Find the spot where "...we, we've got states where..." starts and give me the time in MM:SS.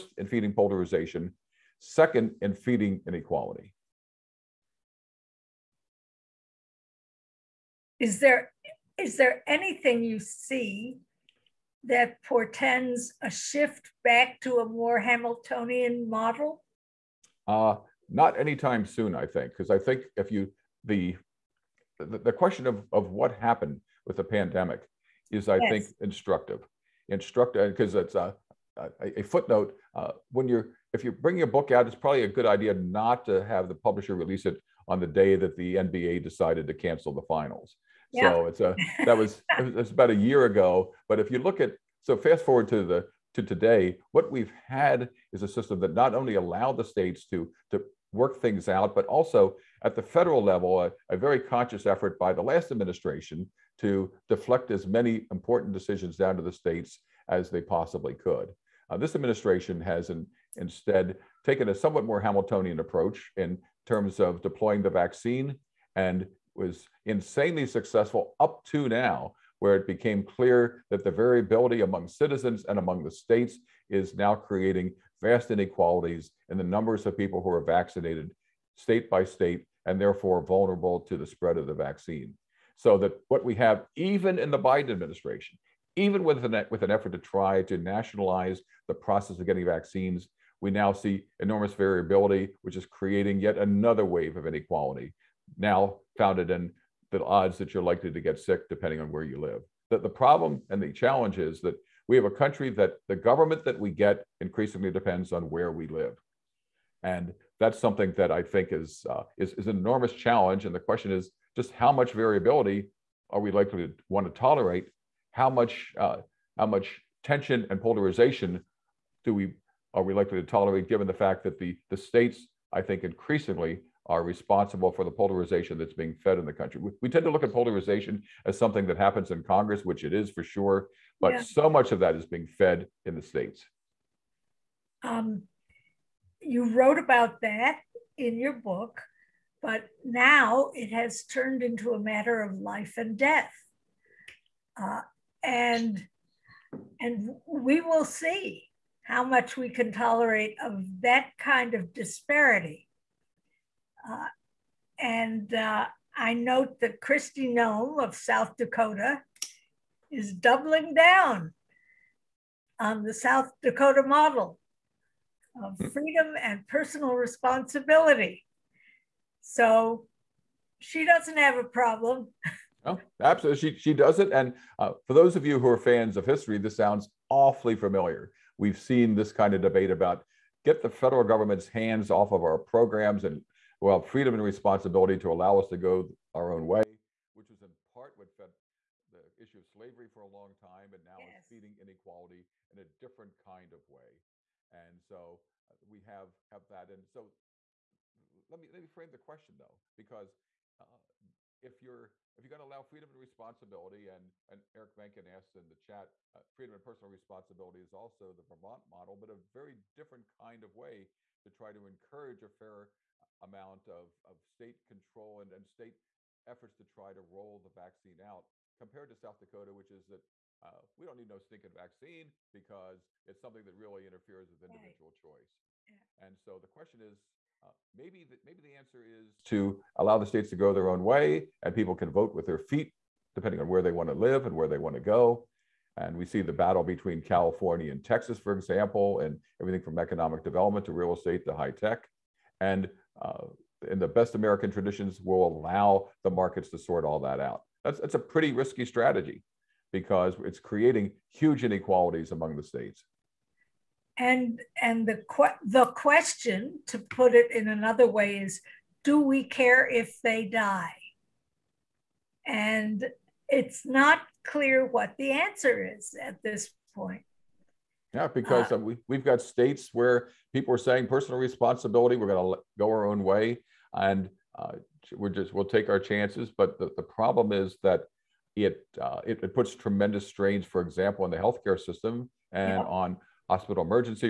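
04:28.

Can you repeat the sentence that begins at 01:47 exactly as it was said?
And that's something that I think is, uh, is, is an enormous challenge.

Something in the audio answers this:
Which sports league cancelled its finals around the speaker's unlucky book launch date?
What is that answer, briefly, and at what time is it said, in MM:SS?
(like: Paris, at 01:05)
NBA, at 00:35.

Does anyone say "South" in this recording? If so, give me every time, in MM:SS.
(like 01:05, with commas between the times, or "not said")
02:38, 02:43, 03:39.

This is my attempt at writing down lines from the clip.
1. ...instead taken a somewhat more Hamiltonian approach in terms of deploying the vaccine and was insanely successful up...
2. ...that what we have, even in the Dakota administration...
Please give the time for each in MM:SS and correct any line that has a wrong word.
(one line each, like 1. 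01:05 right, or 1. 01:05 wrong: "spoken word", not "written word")
1. 01:00 right
2. 01:22 wrong: "Biden", not "Dakota".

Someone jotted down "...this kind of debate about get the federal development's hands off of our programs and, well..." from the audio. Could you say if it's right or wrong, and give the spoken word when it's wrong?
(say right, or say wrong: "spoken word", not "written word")
wrong: "government", not "development".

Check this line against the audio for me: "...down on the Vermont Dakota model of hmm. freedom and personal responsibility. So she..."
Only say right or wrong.
wrong.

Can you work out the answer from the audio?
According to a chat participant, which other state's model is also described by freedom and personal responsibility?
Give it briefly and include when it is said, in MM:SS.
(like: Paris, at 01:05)
Vermont, at 03:28.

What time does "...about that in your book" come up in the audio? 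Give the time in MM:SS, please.
02:16.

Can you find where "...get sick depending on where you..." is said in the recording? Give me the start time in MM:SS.
01:38.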